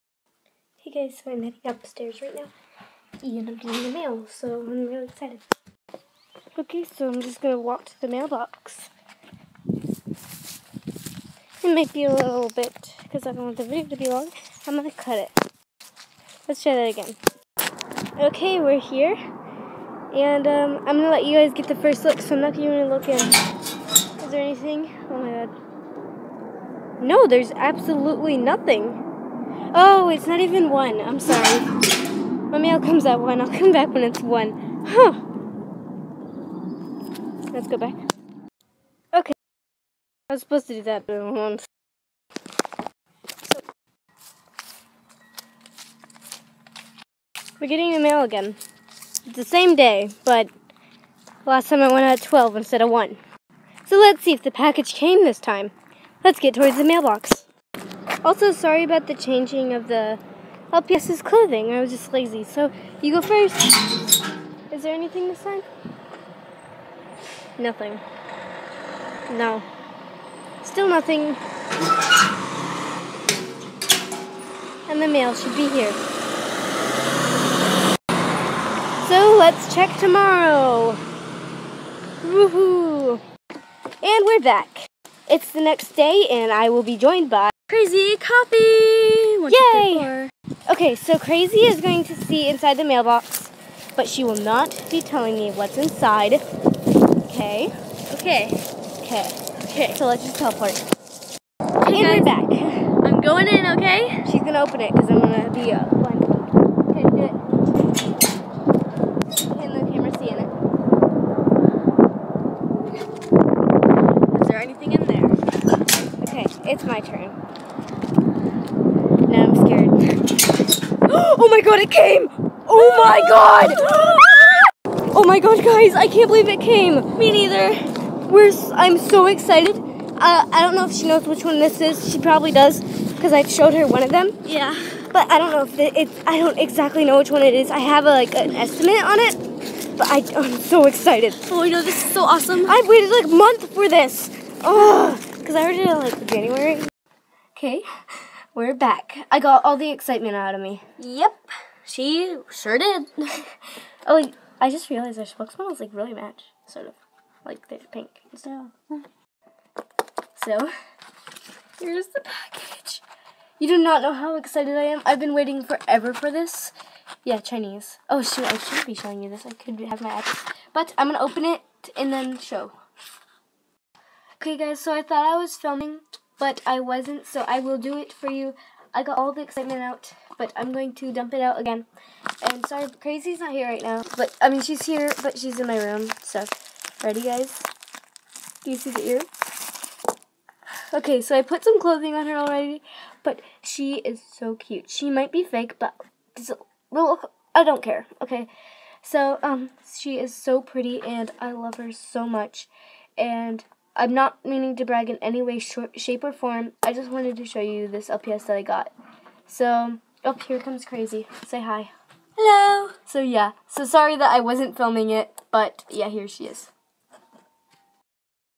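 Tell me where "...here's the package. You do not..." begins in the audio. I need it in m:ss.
2:41.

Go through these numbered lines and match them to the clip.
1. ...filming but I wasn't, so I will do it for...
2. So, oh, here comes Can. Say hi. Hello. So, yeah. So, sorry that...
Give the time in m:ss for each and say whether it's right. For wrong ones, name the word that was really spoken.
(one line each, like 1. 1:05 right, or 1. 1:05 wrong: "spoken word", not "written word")
1. 2:55 right
2. 3:29 wrong: "Crazy", not "Can".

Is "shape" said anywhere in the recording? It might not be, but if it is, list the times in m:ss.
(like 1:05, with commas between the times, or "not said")
3:25.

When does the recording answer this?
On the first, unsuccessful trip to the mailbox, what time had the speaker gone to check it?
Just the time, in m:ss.
0:51.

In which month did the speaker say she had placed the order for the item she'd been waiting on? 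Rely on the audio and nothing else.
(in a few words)
January.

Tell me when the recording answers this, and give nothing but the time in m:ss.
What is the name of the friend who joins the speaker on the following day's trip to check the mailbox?
1:27.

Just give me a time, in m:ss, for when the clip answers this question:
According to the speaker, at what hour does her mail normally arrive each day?
0:32.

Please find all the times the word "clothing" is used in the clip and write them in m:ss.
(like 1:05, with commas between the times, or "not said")
1:01, 3:11.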